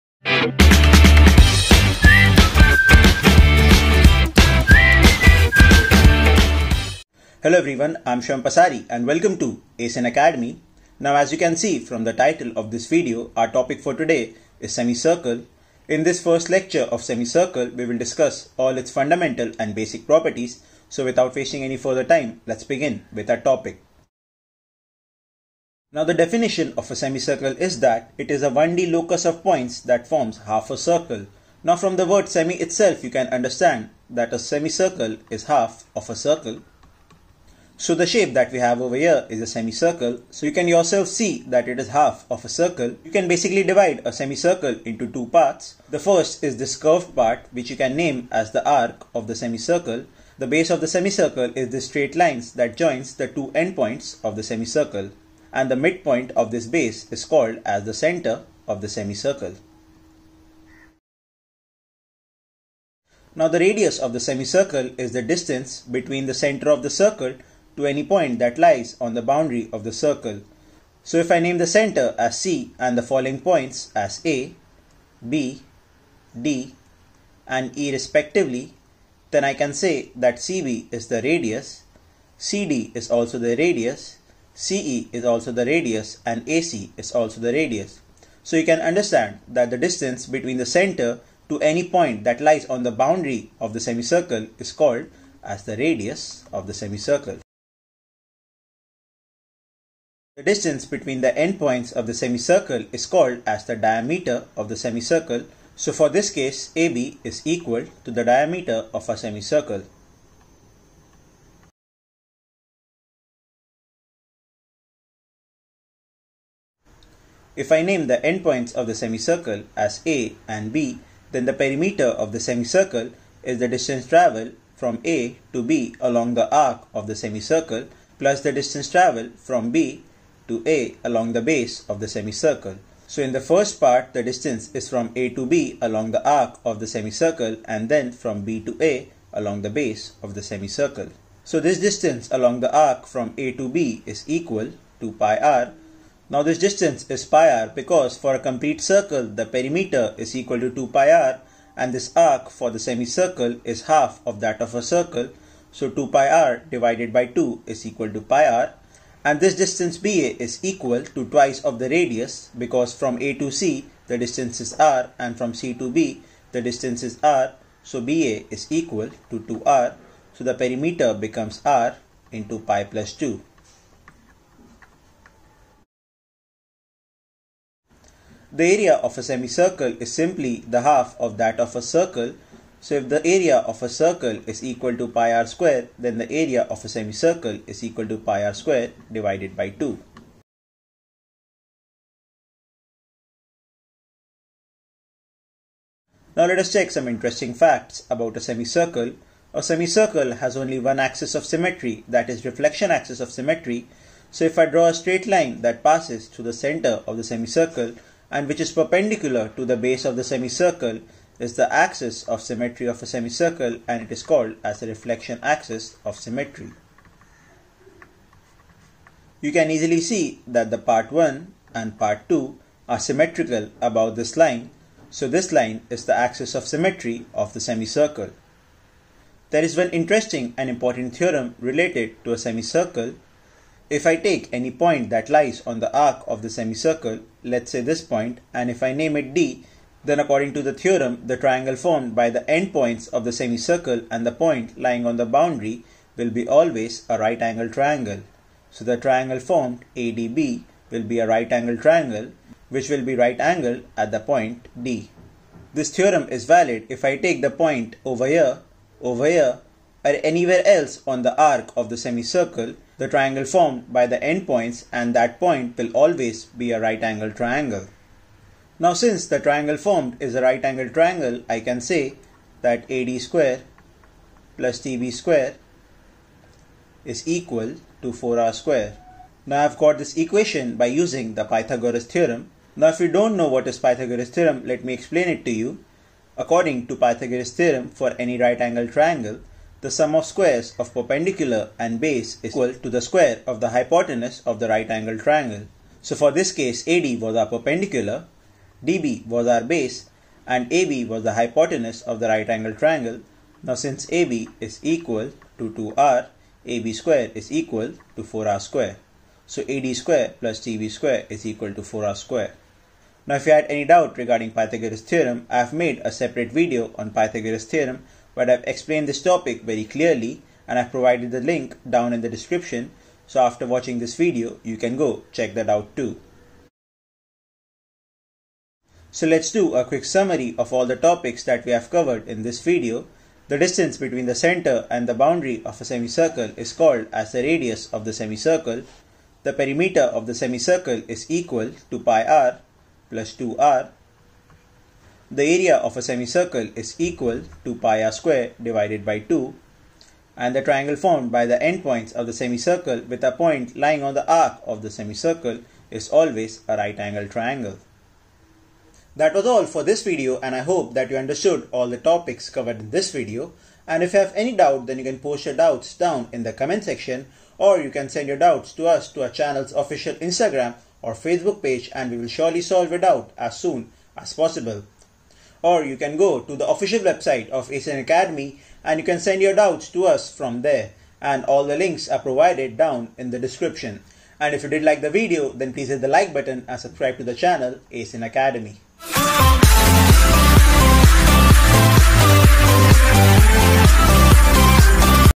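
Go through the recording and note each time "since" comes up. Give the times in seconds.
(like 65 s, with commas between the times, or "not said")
268 s, 303 s.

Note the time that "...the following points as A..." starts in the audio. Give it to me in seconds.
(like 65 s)
72 s.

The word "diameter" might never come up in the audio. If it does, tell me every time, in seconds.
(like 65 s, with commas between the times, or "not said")
103 s, 108 s.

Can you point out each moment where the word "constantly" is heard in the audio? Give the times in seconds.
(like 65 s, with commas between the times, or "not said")
not said.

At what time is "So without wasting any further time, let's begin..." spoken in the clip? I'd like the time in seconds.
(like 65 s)
20 s.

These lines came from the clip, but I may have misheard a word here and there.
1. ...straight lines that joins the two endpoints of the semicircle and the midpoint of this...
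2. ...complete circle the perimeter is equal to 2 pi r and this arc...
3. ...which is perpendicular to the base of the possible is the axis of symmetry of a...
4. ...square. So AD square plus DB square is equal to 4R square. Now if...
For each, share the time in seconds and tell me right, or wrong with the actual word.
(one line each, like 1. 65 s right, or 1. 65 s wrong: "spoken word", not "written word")
1. 51 s right
2. 148 s right
3. 208 s wrong: "semicircle", not "possible"
4. 308 s right.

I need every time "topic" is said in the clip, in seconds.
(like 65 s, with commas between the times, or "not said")
13 s, 23 s, 319 s, 330 s, 361 s.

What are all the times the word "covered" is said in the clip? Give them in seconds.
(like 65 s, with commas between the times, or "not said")
331 s, 362 s.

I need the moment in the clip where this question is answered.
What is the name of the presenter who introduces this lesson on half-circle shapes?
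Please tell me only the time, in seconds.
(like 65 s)
8 s.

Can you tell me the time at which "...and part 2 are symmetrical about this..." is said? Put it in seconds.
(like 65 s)
221 s.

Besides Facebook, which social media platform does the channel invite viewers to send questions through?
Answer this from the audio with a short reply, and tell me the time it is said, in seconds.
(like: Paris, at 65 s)
Instagram, at 370 s.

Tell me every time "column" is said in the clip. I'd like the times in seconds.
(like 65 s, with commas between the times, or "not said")
not said.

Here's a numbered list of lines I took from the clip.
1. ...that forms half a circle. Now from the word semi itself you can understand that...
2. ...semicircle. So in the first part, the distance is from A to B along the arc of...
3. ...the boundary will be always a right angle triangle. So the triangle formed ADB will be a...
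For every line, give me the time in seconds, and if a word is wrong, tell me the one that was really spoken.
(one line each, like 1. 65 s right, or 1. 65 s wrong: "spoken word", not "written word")
1. 29 s right
2. 132 s right
3. 245 s right.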